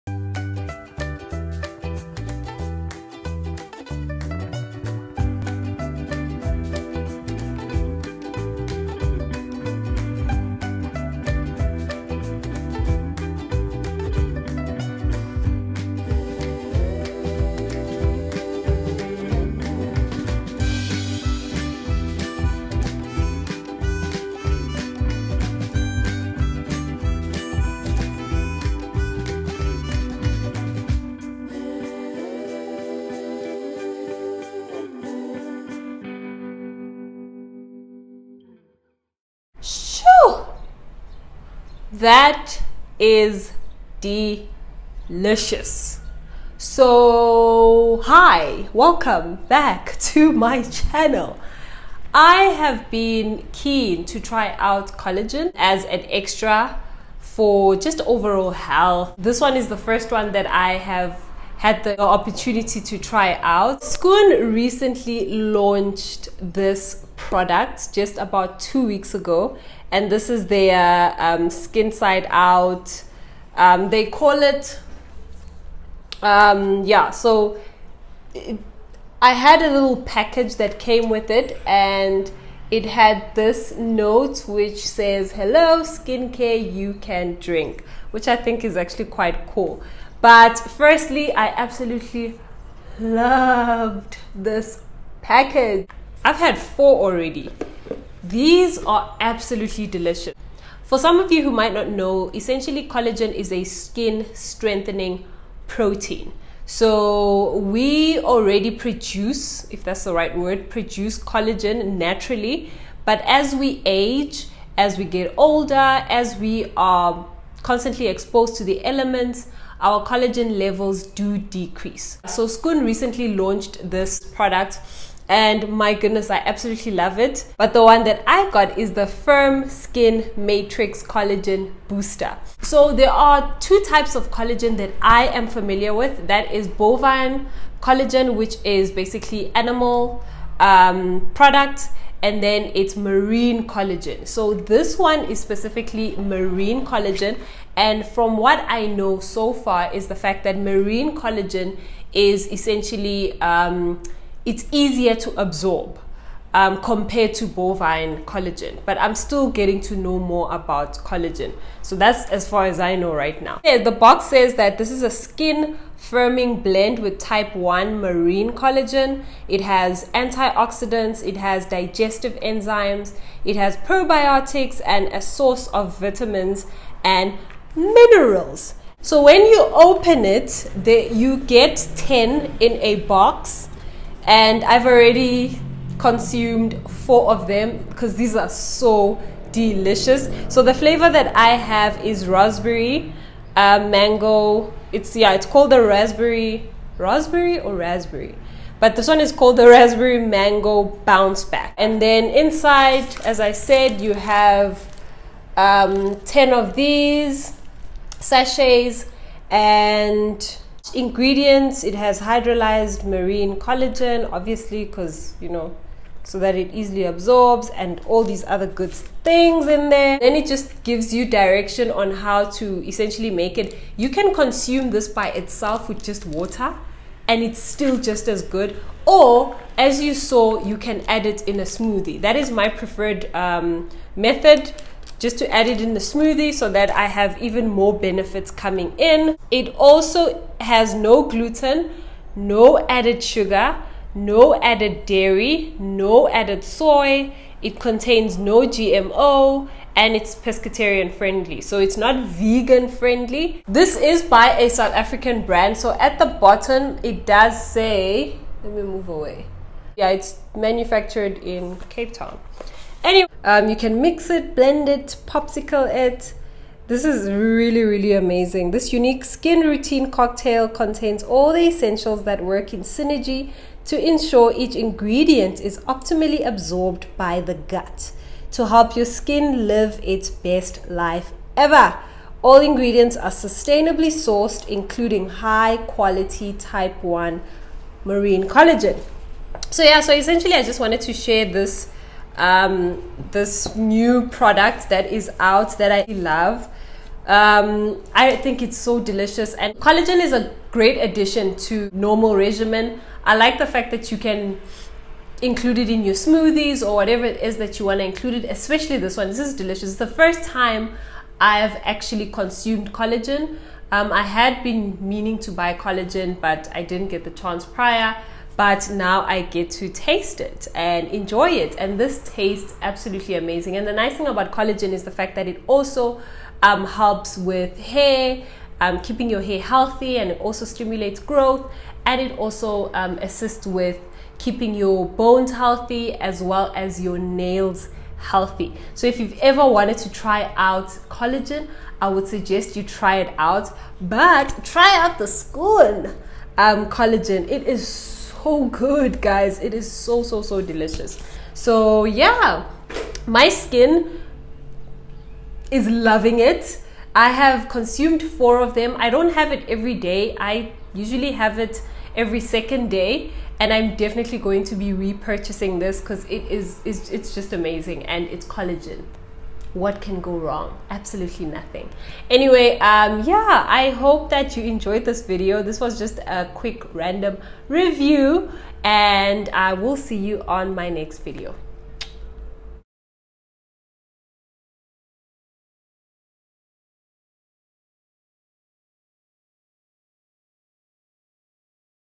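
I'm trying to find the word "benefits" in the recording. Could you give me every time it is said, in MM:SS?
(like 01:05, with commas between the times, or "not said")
03:57.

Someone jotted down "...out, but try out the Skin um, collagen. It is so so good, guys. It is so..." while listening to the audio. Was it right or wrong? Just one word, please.
wrong.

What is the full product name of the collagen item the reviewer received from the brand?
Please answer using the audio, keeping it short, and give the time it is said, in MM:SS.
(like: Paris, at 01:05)
Firm Skin Matrix Collagen Booster, at 02:09.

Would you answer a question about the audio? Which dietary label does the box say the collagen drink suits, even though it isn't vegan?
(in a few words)
Pescatarian.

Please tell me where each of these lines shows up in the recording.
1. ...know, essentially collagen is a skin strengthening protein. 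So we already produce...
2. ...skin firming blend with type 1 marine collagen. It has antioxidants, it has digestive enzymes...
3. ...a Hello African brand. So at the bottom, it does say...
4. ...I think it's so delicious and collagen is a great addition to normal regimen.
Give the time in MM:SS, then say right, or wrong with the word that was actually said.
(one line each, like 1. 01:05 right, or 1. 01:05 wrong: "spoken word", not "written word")
1. 01:41 right
2. 02:45 right
3. 04:14 wrong: "South", not "Hello"
4. 04:58 right.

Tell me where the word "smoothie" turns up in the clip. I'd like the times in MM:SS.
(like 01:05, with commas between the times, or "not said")
03:51, 03:55, 05:06.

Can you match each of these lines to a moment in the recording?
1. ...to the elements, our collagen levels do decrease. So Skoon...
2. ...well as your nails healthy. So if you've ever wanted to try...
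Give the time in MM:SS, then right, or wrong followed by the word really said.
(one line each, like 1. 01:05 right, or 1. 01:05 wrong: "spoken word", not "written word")
1. 01:58 right
2. 05:36 right.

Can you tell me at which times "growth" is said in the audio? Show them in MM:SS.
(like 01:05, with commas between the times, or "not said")
05:31.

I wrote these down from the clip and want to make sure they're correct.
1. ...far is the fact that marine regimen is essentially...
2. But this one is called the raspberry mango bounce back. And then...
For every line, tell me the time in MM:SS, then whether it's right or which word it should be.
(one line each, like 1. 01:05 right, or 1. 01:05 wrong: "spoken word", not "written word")
1. 02:29 wrong: "collagen", not "regimen"
2. 03:18 right.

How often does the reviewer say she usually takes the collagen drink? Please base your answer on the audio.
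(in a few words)
Every second day.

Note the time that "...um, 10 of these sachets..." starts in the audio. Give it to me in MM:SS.
03:25.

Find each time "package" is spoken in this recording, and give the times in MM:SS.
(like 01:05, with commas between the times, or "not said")
01:20, 01:35.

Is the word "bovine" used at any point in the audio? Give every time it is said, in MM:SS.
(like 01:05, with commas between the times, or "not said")
02:16, 02:37.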